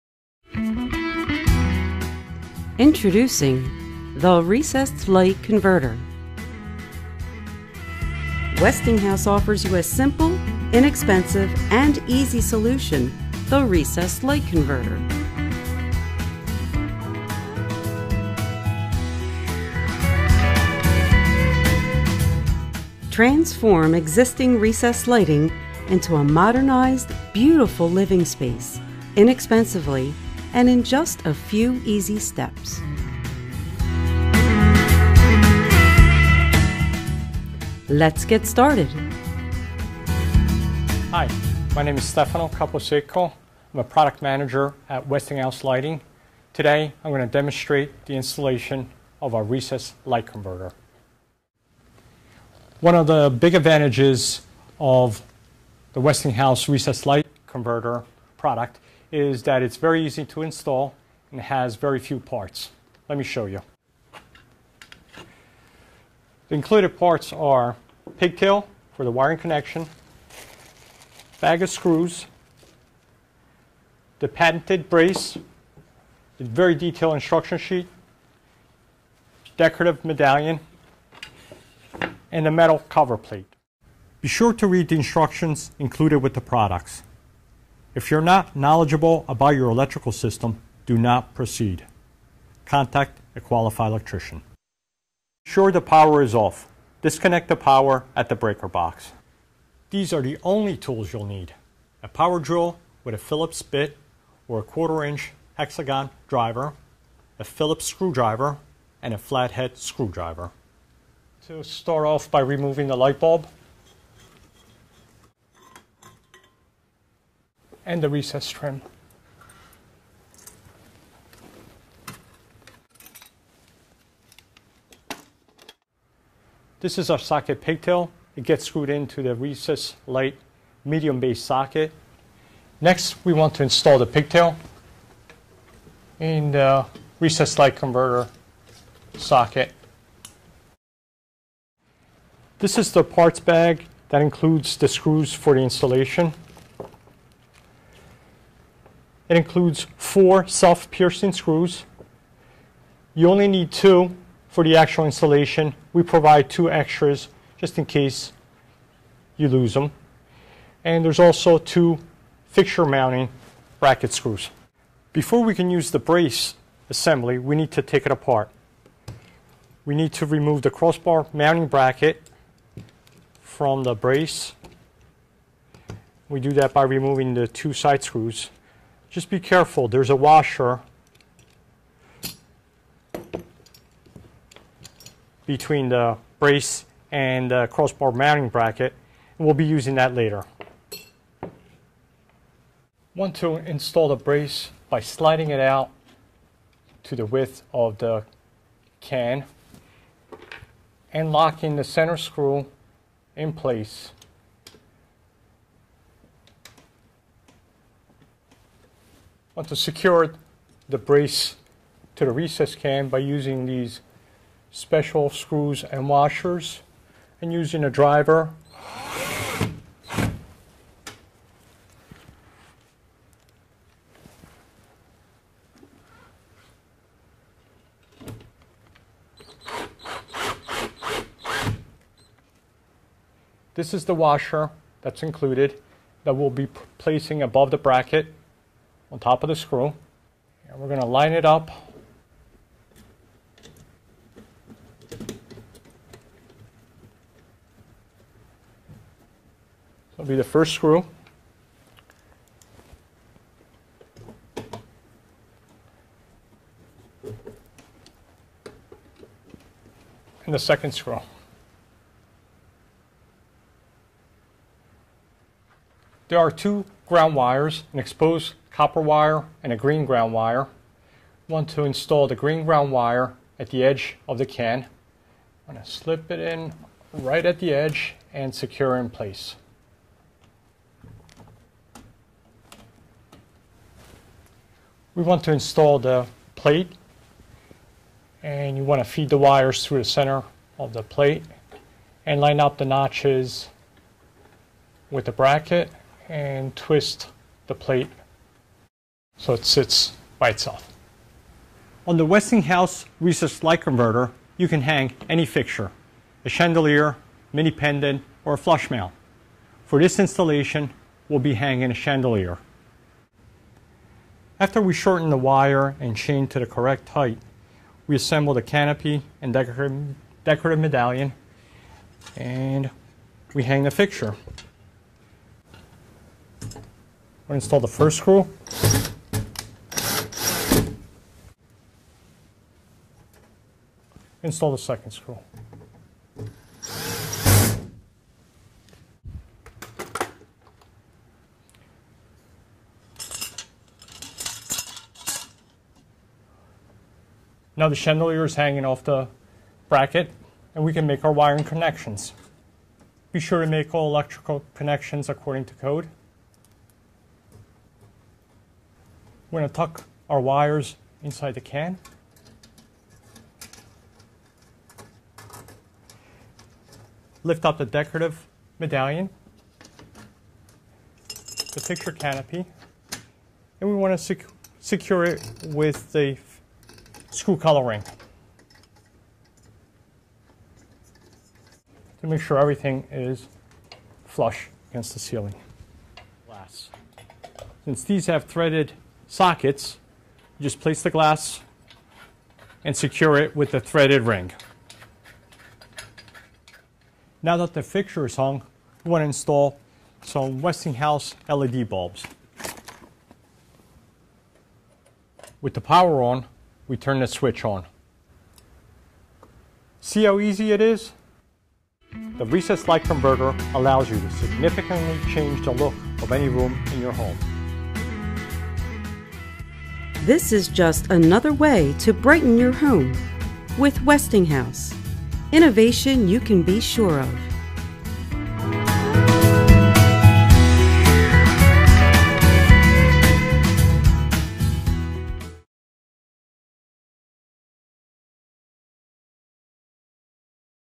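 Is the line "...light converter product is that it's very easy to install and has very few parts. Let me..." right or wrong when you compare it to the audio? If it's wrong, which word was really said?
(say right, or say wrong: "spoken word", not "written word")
right.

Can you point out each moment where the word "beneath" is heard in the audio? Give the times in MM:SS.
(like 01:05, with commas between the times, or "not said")
not said.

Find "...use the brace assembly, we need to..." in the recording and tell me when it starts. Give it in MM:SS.
02:45.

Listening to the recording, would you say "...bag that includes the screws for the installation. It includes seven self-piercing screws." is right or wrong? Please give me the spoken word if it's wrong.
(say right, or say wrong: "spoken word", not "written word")
wrong: "four", not "seven".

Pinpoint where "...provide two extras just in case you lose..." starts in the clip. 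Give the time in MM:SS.
02:36.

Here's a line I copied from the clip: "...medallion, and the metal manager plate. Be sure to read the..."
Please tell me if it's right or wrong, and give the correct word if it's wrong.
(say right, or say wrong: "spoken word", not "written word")
wrong: "cover", not "manager".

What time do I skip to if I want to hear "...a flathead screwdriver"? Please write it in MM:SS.
01:49.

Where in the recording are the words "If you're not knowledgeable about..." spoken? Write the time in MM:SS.
01:27.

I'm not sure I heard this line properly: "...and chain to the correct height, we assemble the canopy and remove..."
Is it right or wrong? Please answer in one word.
wrong.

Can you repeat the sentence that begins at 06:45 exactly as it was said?
With the power on, we turn the switch on.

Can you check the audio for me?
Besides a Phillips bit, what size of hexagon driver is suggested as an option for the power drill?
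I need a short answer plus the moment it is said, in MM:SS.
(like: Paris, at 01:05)
quarter inch, at 01:44.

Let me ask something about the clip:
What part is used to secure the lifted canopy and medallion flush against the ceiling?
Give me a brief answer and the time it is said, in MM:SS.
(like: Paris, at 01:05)
screw collar ring, at 06:17.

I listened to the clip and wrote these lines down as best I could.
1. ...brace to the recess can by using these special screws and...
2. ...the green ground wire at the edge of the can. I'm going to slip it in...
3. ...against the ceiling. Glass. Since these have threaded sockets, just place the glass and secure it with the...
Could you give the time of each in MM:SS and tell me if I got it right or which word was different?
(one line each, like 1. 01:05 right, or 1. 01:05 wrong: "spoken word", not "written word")
1. 03:30 right
2. 04:32 right
3. 06:24 right.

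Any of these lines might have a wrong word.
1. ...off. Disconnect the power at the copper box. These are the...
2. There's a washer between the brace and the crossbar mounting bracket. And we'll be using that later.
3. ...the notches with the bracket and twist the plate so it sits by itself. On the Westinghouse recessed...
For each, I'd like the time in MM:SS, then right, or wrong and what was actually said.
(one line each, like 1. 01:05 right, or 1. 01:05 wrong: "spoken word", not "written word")
1. 01:36 wrong: "breaker", not "copper"
2. 02:59 right
3. 04:52 right.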